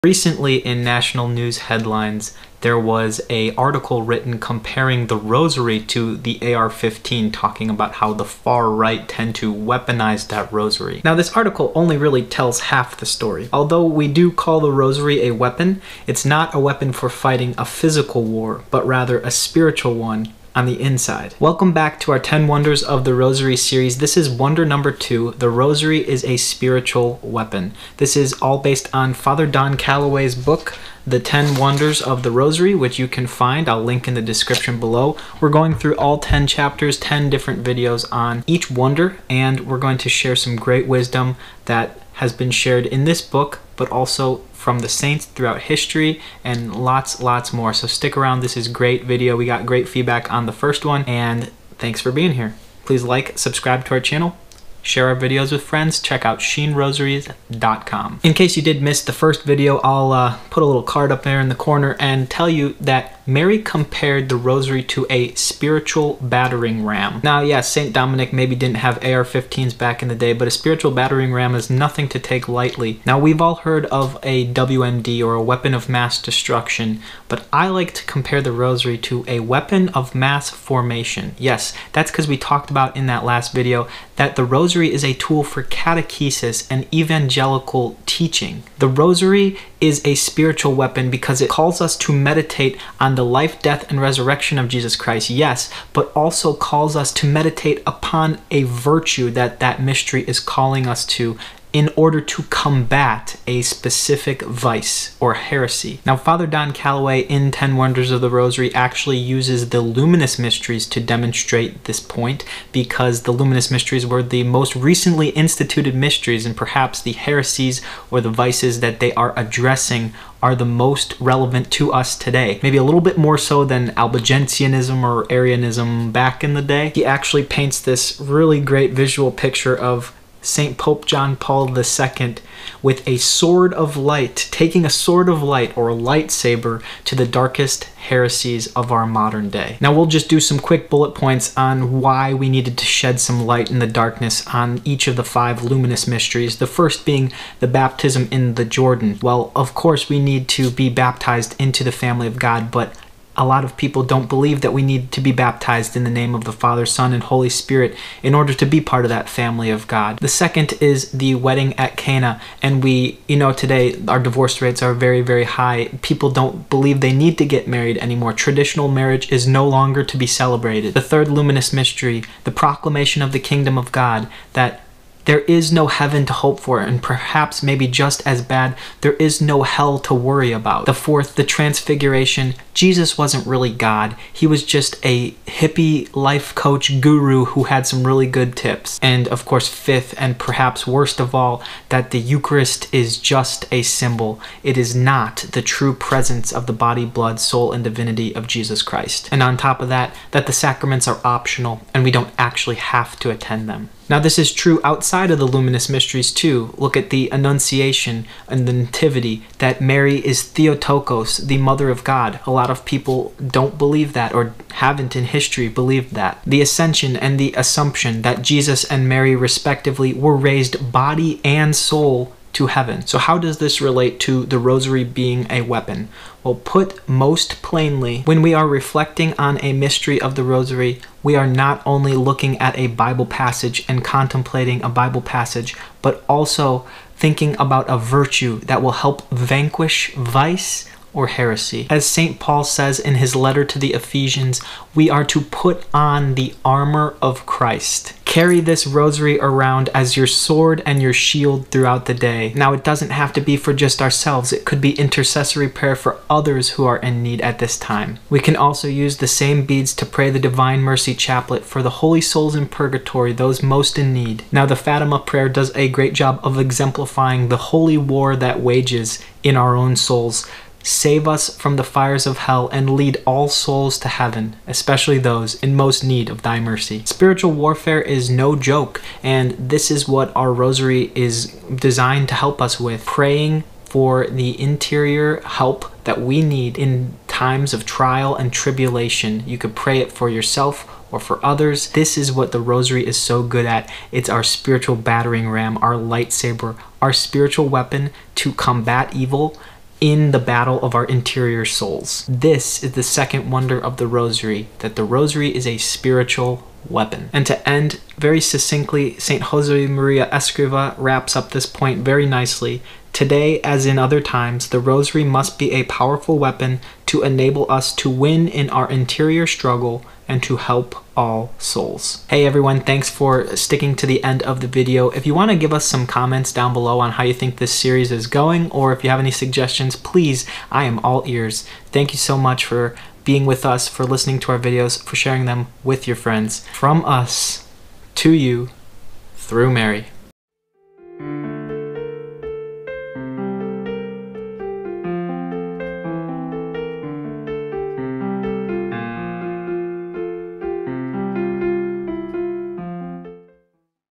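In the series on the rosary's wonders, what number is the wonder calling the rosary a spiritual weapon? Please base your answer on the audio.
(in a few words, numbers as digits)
2.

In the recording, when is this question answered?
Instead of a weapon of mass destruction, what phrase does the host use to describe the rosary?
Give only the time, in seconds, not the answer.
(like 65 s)
79 s.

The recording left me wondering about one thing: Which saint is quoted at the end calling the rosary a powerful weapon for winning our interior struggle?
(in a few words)
St. Jose Maria Escriva.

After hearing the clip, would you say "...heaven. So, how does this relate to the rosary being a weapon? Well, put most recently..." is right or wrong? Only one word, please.
wrong.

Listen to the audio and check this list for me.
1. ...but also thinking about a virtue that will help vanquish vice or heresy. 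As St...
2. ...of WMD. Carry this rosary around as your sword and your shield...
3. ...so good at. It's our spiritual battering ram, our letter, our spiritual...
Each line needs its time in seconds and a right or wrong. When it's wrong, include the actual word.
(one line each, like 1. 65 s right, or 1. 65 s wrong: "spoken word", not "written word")
1. 236 s right
2. 247 s wrong: "Christ", not "WMD"
3. 293 s wrong: "lightsaber", not "letter".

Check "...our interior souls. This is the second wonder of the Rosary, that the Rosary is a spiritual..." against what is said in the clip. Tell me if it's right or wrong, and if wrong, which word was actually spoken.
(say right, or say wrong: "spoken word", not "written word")
right.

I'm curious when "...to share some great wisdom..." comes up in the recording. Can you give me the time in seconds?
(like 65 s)
39 s.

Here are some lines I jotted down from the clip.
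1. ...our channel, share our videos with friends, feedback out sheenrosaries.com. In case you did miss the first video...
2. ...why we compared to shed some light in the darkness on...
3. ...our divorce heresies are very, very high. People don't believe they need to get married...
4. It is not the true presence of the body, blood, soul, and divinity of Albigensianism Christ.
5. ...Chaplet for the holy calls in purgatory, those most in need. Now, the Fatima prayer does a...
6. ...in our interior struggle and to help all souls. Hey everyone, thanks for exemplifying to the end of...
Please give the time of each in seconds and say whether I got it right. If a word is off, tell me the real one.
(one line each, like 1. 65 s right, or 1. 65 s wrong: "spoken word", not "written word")
1. 53 s wrong: "check", not "feedback"
2. 142 s wrong: "needed", not "compared"
3. 164 s wrong: "rates", not "heresies"
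4. 194 s wrong: "Jesus", not "Albigensianism"
5. 261 s wrong: "souls", not "calls"
6. 318 s wrong: "sticking", not "exemplifying".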